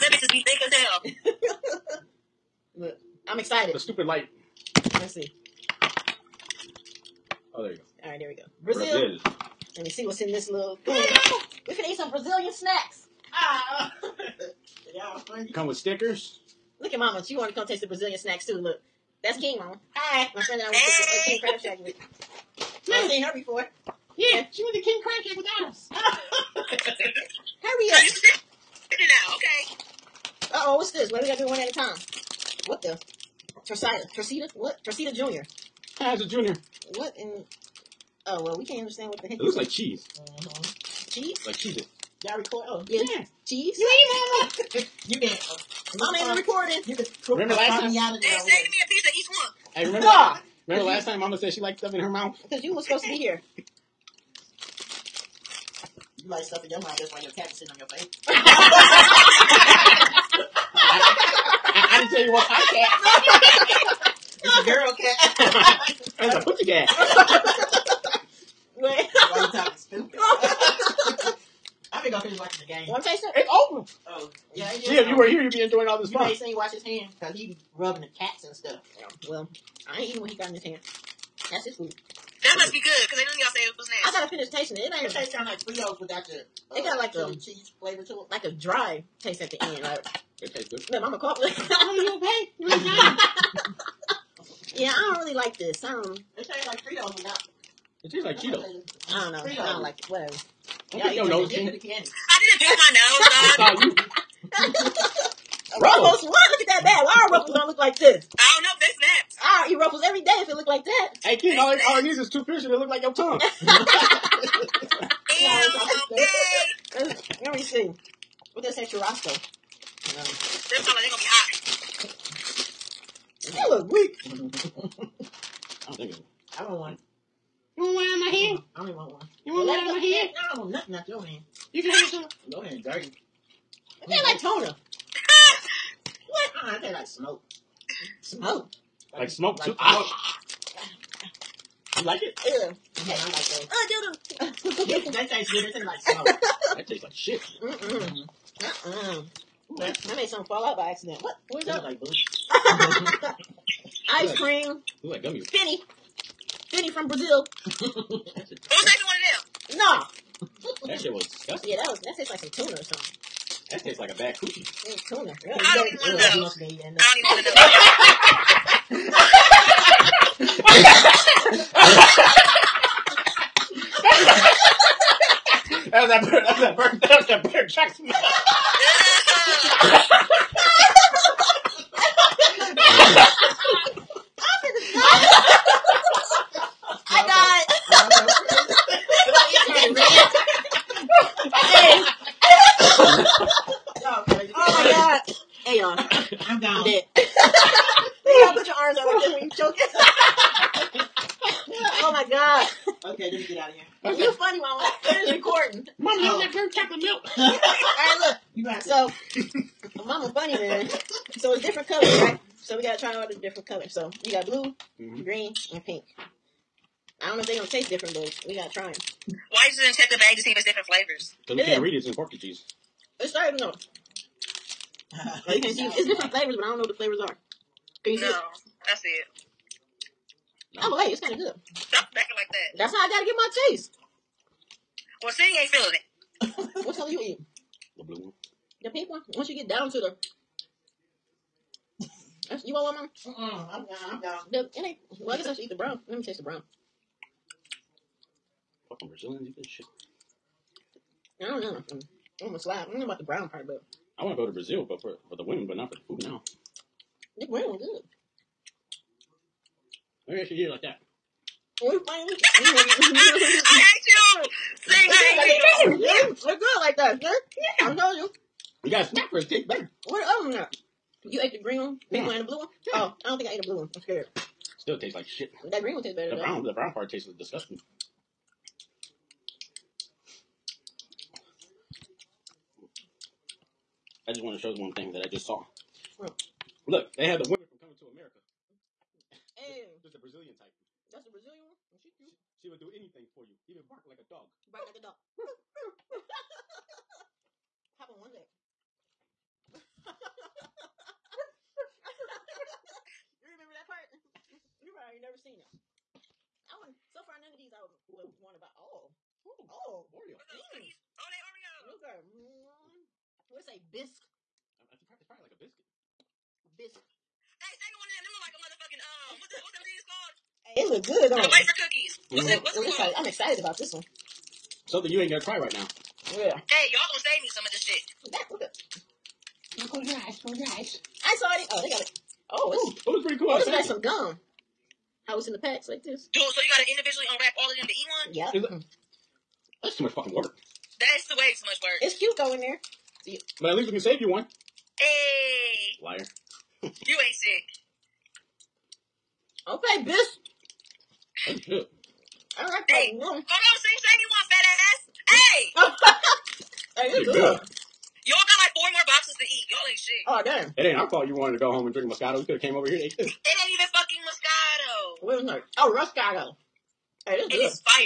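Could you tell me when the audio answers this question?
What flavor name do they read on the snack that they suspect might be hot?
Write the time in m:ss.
1:58.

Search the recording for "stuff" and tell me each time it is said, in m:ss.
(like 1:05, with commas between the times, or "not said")
0:51, 0:56, 1:18.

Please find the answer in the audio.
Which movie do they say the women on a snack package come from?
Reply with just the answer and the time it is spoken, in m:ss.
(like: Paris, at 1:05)
Coming to America, at 4:47.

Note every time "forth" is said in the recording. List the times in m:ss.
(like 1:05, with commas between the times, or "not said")
not said.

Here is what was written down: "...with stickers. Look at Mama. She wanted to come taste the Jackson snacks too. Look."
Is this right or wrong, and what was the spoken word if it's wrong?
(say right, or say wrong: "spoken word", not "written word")
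wrong: "Brazilian", not "Jackson".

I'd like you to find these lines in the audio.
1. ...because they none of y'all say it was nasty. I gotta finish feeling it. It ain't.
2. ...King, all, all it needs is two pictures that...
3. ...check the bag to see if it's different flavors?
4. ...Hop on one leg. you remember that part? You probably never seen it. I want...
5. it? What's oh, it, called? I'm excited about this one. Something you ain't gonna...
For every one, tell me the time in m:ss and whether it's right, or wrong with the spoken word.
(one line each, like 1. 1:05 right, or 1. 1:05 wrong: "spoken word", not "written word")
1. 1:23 wrong: "tasting", not "feeling"
2. 1:51 right
3. 3:39 right
4. 4:57 right
5. 5:22 right.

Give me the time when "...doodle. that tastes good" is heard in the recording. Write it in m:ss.
2:24.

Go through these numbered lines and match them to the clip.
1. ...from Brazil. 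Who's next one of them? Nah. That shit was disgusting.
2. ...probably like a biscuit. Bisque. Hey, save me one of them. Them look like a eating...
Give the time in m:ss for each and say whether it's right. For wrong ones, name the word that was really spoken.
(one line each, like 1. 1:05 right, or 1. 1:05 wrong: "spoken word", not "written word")
1. 2:36 right
2. 5:15 wrong: "motherfucking", not "eating".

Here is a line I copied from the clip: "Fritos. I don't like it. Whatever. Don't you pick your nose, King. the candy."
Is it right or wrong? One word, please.
right.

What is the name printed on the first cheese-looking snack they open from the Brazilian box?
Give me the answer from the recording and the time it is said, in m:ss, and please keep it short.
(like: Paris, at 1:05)
Torcida Jr., at 0:34.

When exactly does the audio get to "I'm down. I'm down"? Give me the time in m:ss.
4:03.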